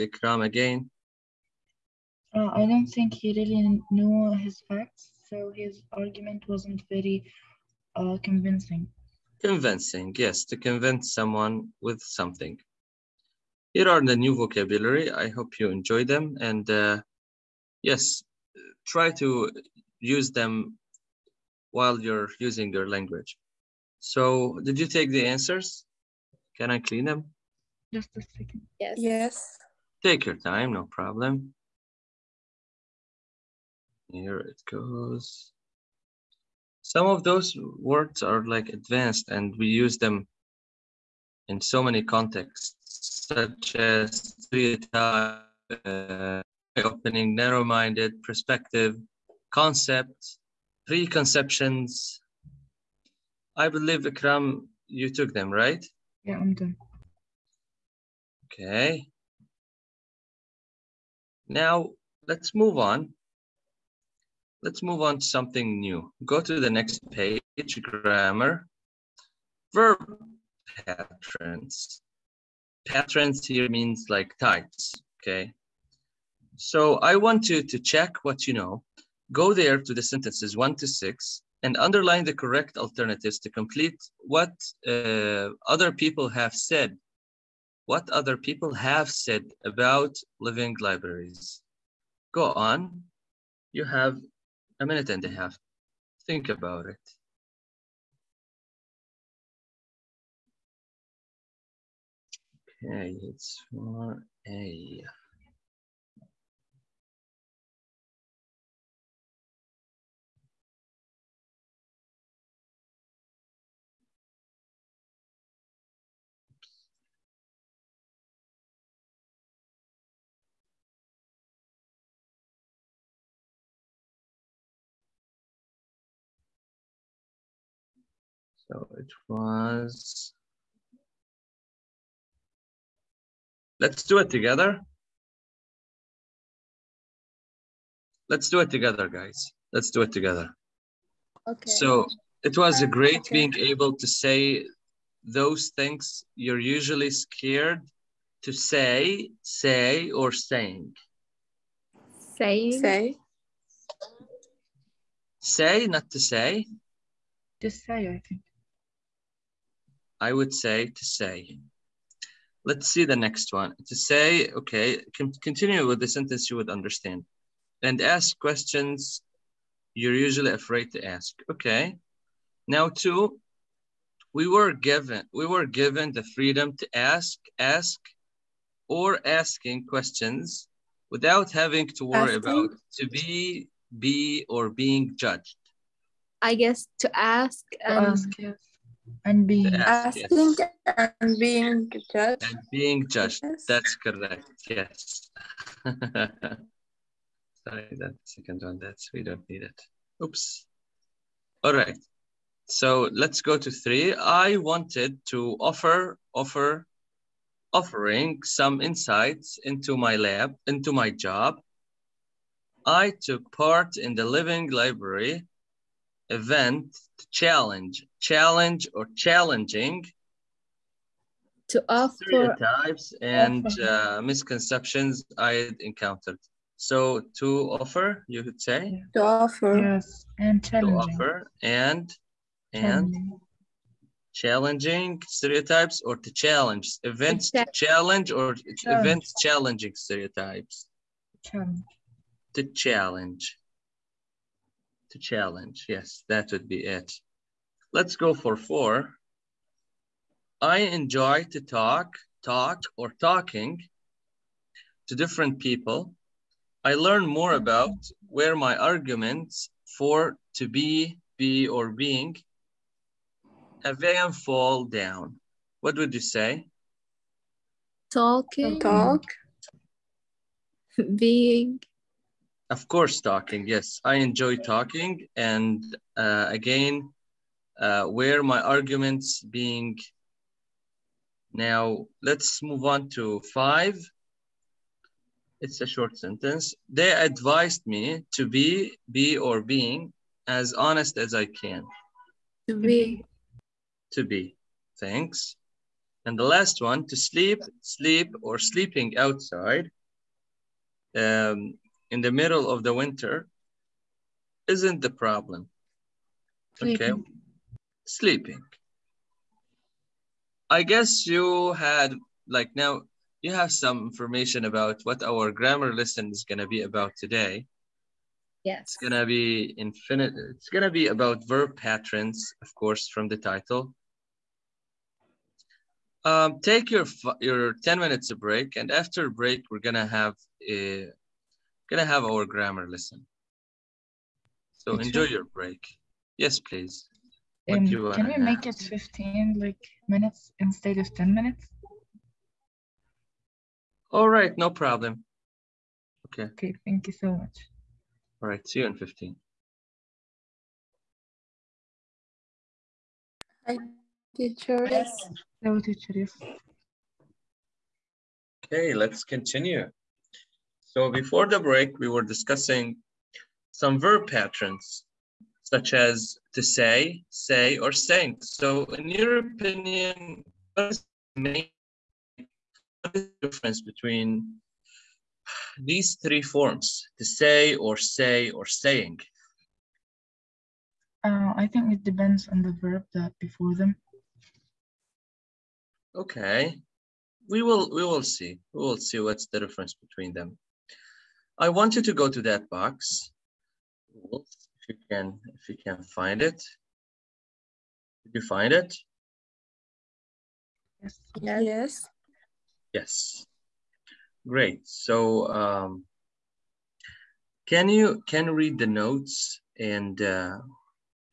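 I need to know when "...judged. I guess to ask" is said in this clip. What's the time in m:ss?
3:05.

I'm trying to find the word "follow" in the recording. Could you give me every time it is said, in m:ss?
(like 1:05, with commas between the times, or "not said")
not said.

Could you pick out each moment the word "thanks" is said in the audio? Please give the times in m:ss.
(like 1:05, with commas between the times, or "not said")
4:55, 5:46.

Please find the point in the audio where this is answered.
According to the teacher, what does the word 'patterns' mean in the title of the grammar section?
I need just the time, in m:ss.
1:14.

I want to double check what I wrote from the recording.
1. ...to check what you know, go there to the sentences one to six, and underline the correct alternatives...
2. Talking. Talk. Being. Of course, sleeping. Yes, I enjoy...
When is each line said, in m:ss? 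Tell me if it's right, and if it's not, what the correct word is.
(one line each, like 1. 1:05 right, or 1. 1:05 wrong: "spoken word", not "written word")
1. 1:17 right
2. 4:28 wrong: "talking", not "sleeping".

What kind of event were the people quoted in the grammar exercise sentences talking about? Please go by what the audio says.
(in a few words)
living libraries.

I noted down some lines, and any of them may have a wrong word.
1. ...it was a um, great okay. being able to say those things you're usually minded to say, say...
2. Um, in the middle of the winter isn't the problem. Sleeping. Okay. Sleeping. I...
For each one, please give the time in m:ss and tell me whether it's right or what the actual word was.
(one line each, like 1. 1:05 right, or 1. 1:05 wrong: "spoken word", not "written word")
1. 2:22 wrong: "scared", not "minded"
2. 5:01 right.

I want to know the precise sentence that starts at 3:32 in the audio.
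I took part in the living library event, to challenge, challenge or challenging to offer stereotypes and uh, misconceptions I encountered.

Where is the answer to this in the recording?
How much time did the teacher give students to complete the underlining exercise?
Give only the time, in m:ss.
1:34.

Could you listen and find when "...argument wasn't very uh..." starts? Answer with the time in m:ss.
0:05.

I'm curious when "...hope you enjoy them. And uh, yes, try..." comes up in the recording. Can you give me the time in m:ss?
0:15.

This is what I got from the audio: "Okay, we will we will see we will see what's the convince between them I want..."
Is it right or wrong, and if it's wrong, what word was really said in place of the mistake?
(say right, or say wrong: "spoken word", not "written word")
wrong: "difference", not "convince".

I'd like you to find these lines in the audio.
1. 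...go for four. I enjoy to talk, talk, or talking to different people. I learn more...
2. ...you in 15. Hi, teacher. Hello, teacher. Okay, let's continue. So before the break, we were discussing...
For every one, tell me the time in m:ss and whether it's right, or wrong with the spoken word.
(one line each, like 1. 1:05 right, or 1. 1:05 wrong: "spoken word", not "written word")
1. 4:08 right
2. 5:48 right.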